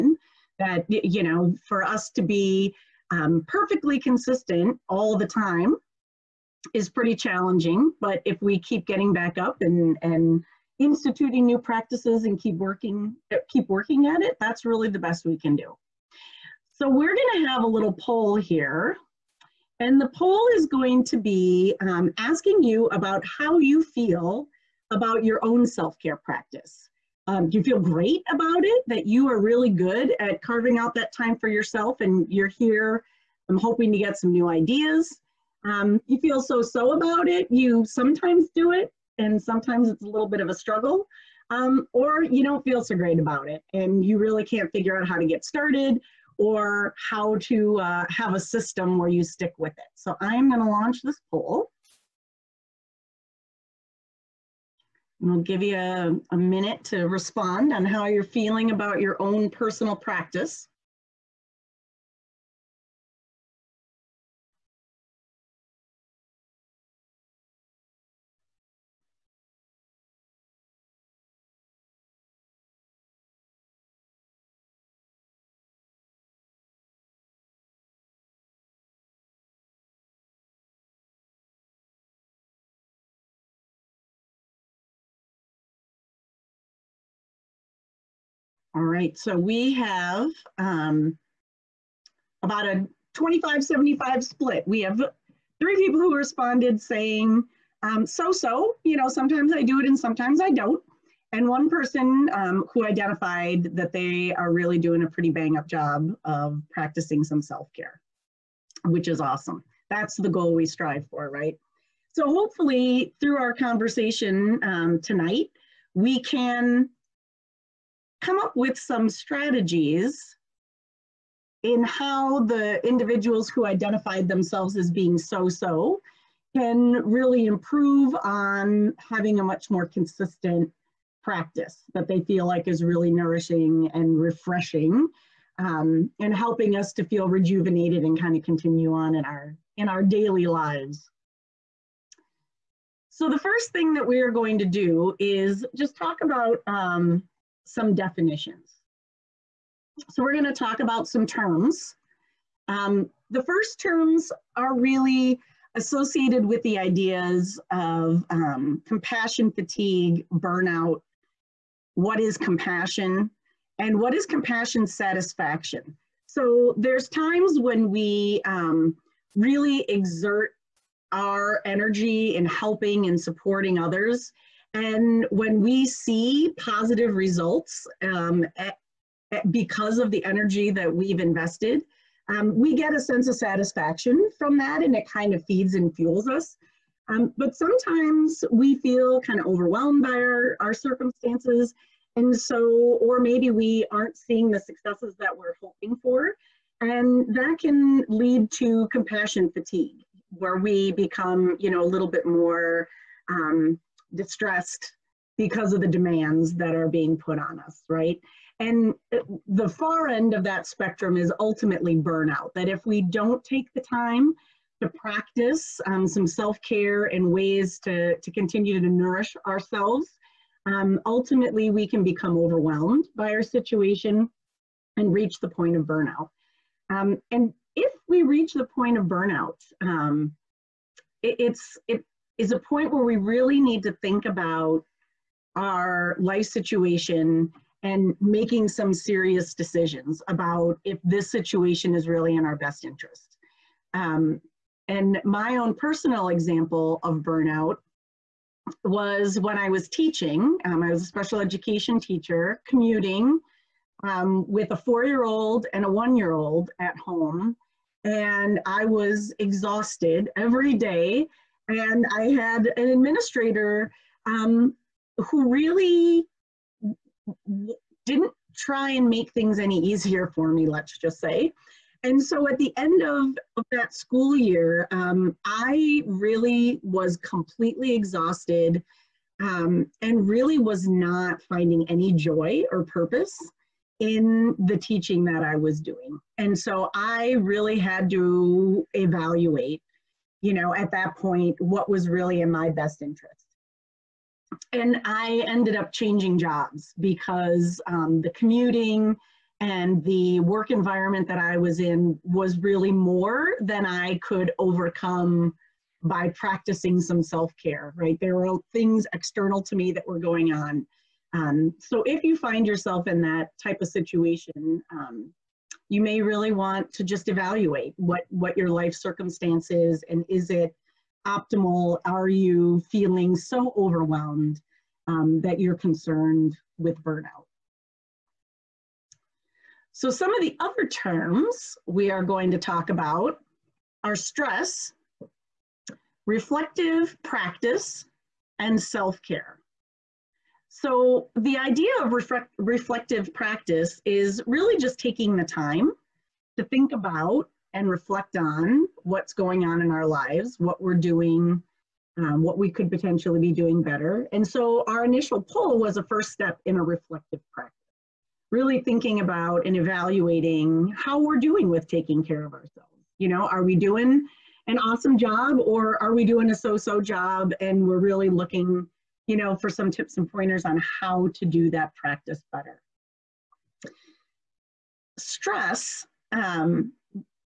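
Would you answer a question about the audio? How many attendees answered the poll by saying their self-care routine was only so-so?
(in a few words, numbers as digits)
3.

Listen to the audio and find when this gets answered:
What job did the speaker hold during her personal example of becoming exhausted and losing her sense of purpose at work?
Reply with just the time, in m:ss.
4:11.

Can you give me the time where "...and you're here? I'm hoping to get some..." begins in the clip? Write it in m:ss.
0:31.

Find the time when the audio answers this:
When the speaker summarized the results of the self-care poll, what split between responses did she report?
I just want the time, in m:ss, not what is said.
1:33.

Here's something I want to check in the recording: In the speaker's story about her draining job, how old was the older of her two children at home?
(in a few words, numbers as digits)
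4.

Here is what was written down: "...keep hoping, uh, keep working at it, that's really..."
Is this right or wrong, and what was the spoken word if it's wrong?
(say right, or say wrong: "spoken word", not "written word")
wrong: "working", not "hoping".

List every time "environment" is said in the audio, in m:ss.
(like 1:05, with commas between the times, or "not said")
5:00.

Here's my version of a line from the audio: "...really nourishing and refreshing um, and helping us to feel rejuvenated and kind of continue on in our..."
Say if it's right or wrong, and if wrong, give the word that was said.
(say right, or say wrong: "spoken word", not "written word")
right.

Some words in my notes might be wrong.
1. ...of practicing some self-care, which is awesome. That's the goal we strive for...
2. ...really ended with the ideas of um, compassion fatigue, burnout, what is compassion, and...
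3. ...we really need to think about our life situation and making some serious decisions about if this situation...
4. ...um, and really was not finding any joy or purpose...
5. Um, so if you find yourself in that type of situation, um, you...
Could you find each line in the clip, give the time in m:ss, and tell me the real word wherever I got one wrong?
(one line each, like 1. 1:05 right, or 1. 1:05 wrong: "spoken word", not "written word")
1. 1:46 right
2. 2:34 wrong: "associated", not "ended"
3. 3:53 right
4. 4:39 right
5. 5:11 right.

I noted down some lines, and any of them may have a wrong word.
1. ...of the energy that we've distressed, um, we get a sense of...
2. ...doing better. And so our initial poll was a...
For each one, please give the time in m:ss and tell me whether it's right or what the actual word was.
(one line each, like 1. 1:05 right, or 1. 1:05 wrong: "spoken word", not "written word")
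1. 2:59 wrong: "invested", not "distressed"
2. 5:53 right.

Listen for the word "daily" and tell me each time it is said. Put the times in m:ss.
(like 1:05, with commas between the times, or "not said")
2:20.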